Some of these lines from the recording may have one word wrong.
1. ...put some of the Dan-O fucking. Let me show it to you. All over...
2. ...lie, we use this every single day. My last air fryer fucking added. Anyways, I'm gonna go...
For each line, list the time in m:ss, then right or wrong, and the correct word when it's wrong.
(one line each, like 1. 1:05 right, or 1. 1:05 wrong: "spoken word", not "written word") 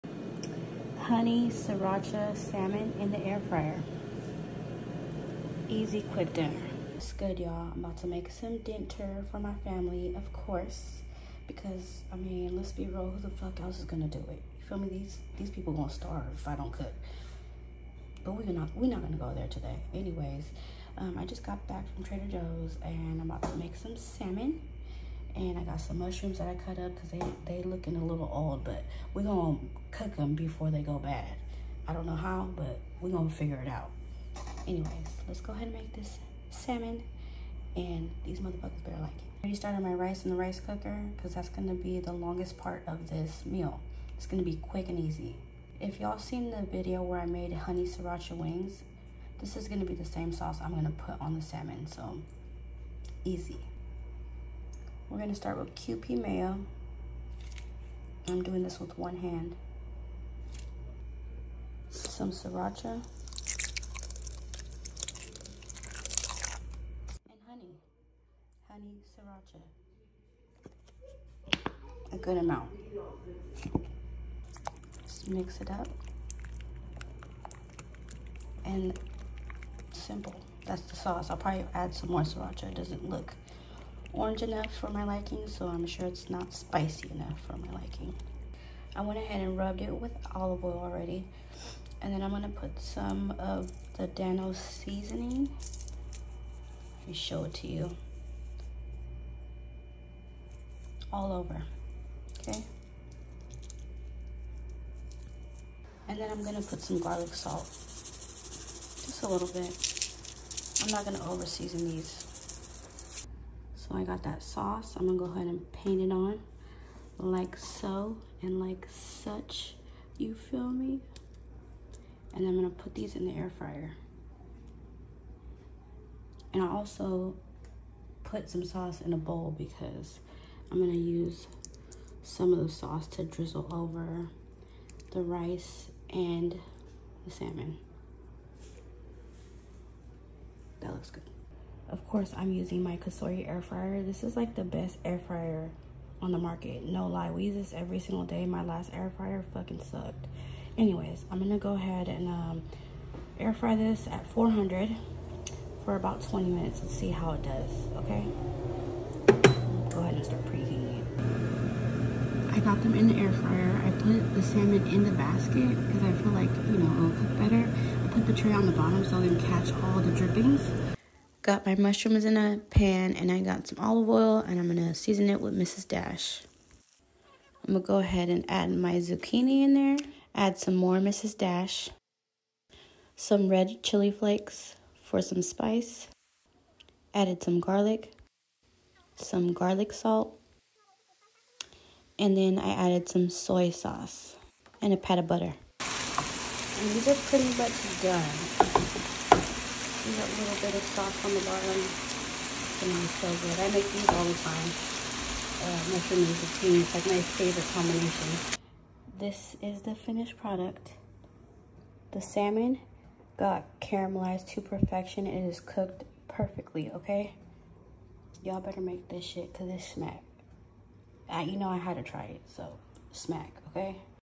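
1. 1:32 wrong: "seasoning", not "fucking"
2. 2:27 wrong: "sucked", not "added".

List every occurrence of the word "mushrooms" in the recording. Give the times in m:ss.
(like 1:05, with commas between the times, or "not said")
0:25, 2:51, 3:25.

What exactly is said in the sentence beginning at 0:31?
I don't know how, but we're going to figure it out.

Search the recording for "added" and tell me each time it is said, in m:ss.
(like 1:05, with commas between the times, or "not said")
3:07, 3:12.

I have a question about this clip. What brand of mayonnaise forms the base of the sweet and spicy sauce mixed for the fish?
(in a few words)
Kewpie.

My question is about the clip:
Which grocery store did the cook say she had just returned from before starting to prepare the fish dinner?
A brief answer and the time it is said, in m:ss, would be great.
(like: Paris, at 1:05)
Trader Joe's, at 0:22.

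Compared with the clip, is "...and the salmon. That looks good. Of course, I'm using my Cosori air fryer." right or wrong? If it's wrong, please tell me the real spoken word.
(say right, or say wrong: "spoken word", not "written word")
right.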